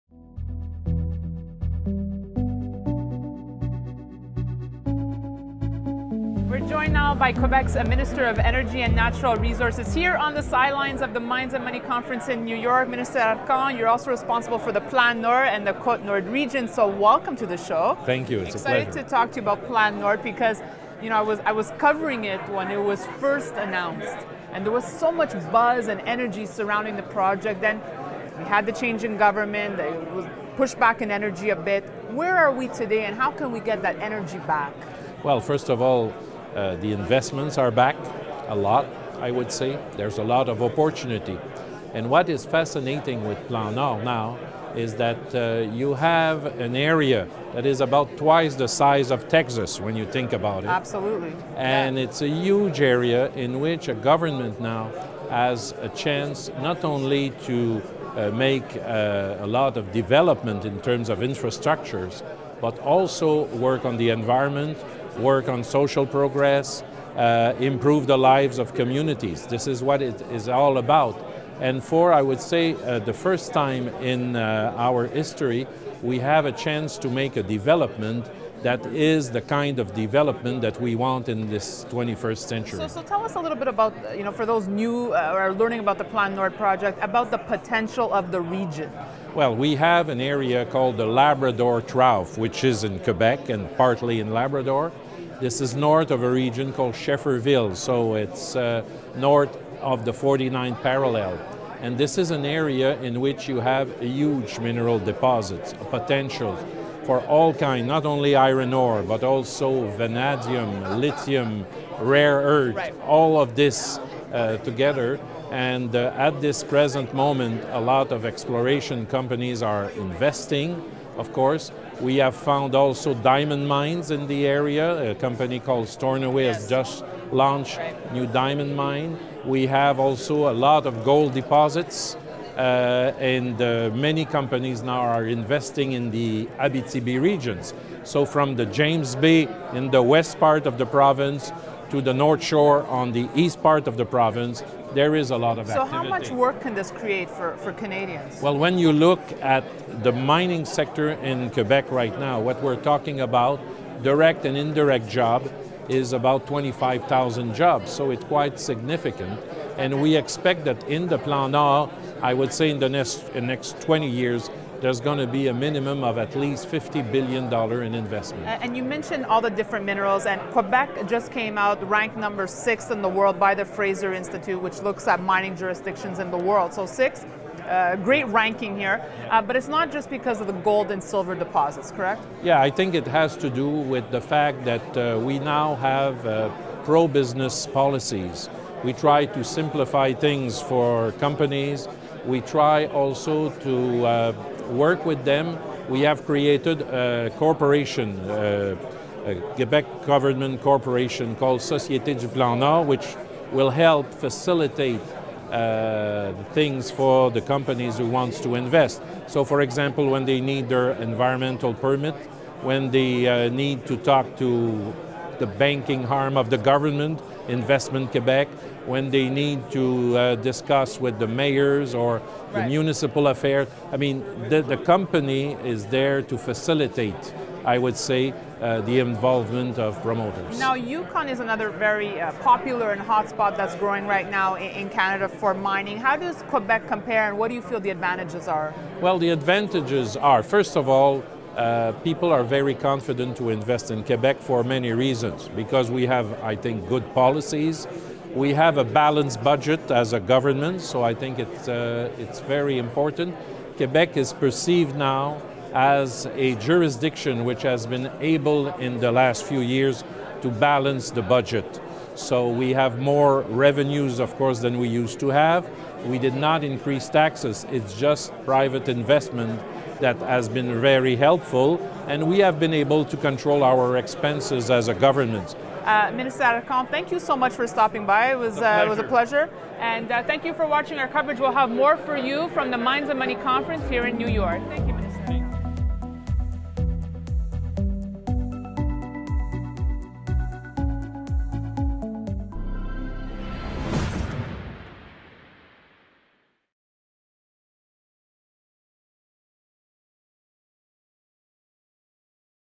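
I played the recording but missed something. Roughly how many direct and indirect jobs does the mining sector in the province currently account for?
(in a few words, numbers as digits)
25,000.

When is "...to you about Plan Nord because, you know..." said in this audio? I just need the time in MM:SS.
00:19.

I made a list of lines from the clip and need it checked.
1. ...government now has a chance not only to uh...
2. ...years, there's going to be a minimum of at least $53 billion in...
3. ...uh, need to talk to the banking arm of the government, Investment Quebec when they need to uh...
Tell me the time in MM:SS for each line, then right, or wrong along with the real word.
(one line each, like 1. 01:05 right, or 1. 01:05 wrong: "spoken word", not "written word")
1. 00:53 right
2. 02:44 wrong: "50", not "53"
3. 03:33 right.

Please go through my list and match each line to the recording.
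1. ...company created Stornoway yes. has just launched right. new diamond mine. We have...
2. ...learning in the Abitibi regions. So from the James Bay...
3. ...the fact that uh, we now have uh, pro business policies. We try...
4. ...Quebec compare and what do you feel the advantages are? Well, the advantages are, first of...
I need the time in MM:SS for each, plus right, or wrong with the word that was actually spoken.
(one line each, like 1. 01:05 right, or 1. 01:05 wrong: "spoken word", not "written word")
1. 02:05 wrong: "called", not "created"
2. 02:15 wrong: "investing", not "learning"
3. 03:04 right
4. 03:56 right.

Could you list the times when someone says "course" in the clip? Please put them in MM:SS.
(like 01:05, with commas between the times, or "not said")
02:01, 04:24.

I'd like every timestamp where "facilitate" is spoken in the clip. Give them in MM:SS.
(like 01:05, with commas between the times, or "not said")
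03:24, 03:46.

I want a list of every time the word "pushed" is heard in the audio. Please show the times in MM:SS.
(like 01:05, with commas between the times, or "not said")
00:30.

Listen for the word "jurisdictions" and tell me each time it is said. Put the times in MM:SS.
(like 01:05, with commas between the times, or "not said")
02:55, 04:16.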